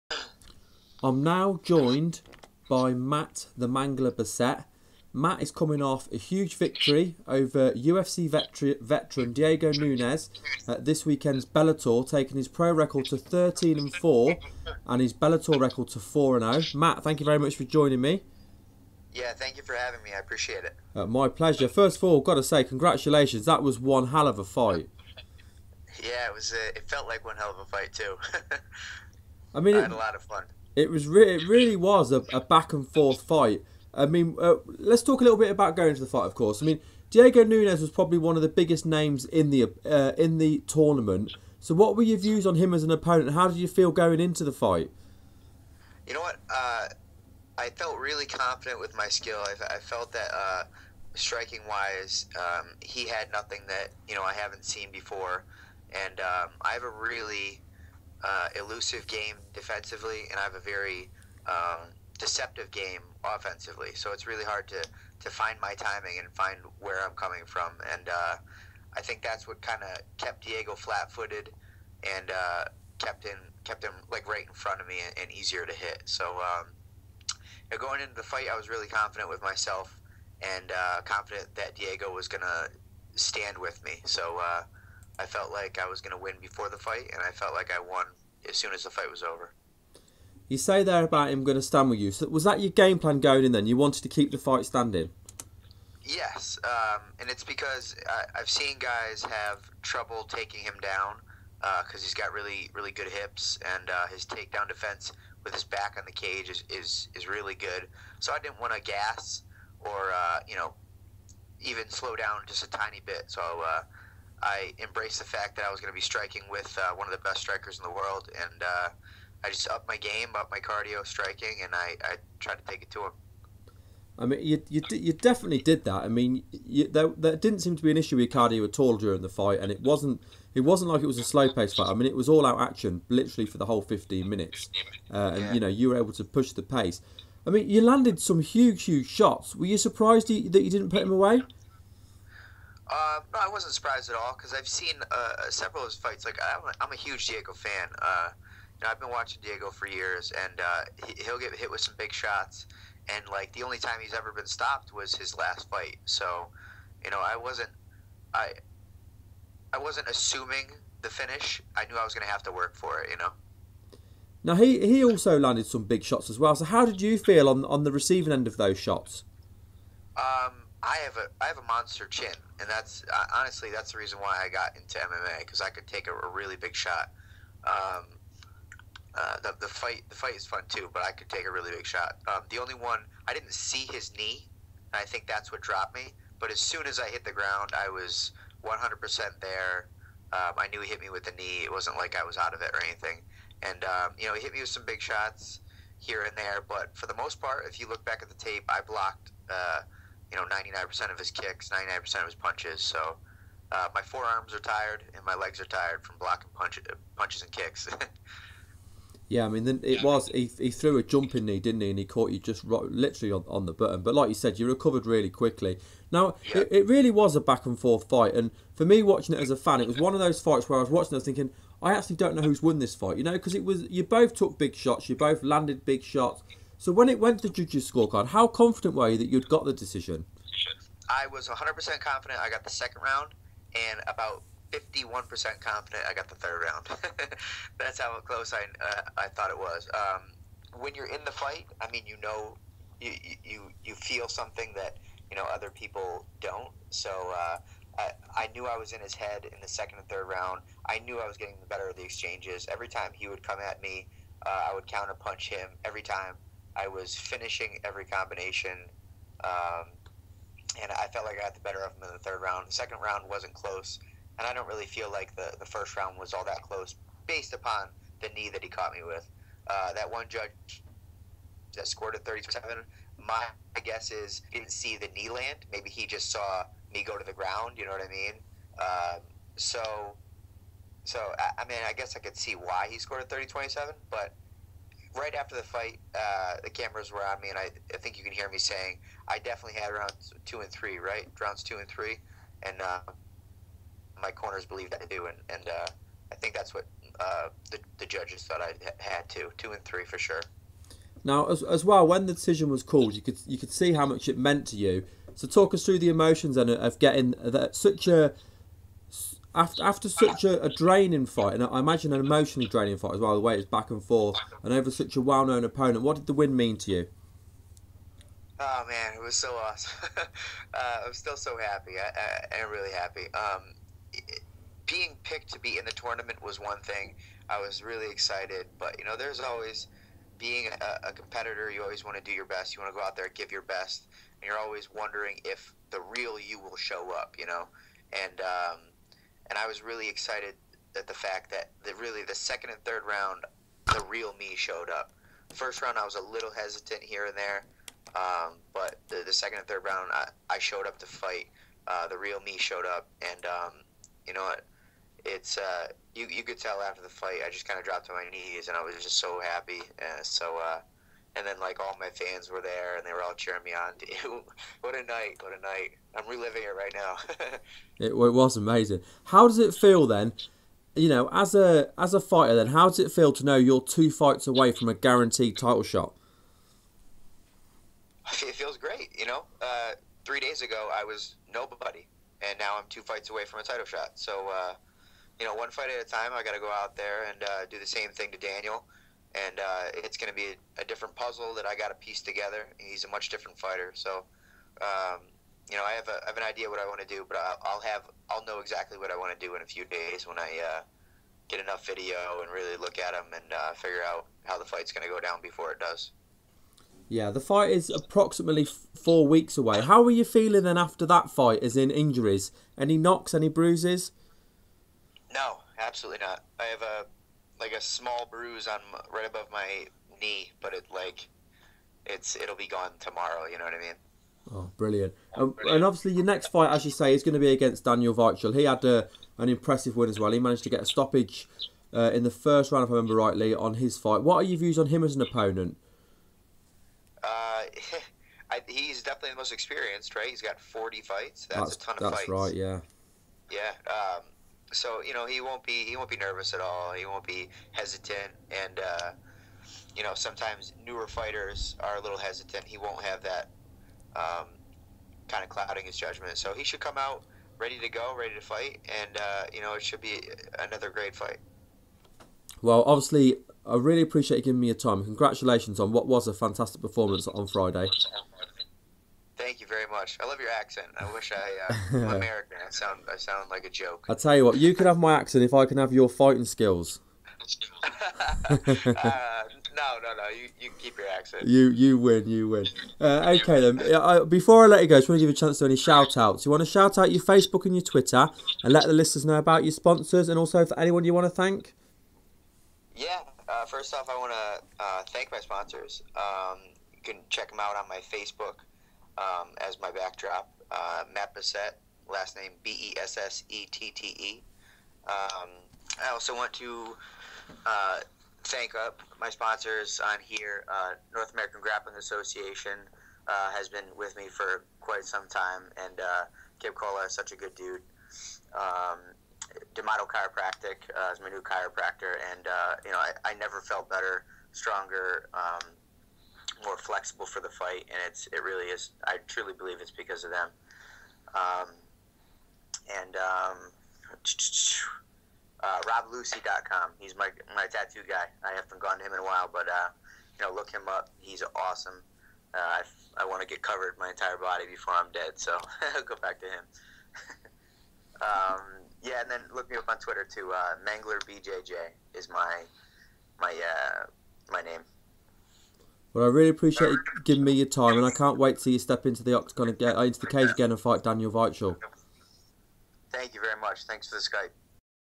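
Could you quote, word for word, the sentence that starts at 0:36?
Of course, I mean Diego Nunes was probably one of the biggest names in the uh, in the tournament.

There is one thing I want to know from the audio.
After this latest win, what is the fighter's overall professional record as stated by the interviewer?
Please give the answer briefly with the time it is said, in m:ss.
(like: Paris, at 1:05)
13 and 4, at 0:13.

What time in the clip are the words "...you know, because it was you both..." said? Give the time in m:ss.
3:43.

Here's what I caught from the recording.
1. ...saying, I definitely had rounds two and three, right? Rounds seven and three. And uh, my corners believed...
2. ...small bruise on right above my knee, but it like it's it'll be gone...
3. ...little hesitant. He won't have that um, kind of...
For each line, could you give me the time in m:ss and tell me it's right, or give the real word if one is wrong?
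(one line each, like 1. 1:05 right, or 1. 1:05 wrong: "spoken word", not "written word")
1. 4:48 wrong: "two", not "seven"
2. 6:57 right
3. 7:32 right.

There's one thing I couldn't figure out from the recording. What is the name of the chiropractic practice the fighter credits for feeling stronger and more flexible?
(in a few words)
D'Amato Chiropractic.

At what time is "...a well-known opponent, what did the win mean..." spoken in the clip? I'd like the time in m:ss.
5:15.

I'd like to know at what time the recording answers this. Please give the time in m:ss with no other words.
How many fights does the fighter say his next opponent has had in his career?
7:20.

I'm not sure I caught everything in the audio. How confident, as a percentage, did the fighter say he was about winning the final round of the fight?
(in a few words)
51%.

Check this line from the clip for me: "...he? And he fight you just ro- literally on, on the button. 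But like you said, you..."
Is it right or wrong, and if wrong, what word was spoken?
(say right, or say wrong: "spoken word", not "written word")
wrong: "caught", not "fight".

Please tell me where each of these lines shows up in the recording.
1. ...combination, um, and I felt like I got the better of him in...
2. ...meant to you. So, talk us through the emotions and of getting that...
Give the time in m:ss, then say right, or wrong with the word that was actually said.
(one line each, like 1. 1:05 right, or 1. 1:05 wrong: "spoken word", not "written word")
1. 4:18 right
2. 5:04 right.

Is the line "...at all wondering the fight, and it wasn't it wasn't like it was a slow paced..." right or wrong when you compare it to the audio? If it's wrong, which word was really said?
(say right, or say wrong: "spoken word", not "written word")
wrong: "during", not "wondering".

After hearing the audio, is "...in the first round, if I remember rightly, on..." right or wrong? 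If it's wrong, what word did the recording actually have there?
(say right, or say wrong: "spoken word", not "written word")
right.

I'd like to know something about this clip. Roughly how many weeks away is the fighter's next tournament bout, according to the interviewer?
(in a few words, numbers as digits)
four weeks.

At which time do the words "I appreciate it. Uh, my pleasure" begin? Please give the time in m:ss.
0:20.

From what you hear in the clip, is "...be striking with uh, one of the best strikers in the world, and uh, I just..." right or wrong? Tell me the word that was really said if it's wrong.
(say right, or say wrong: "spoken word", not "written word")
right.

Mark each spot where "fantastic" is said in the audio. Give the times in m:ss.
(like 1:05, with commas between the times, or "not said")
7:46.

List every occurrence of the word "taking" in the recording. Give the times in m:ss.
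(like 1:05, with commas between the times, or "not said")
0:12, 1:40.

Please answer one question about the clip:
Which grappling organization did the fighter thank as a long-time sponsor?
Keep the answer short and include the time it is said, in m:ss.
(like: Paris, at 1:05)
North American Grappling Association, at 8:31.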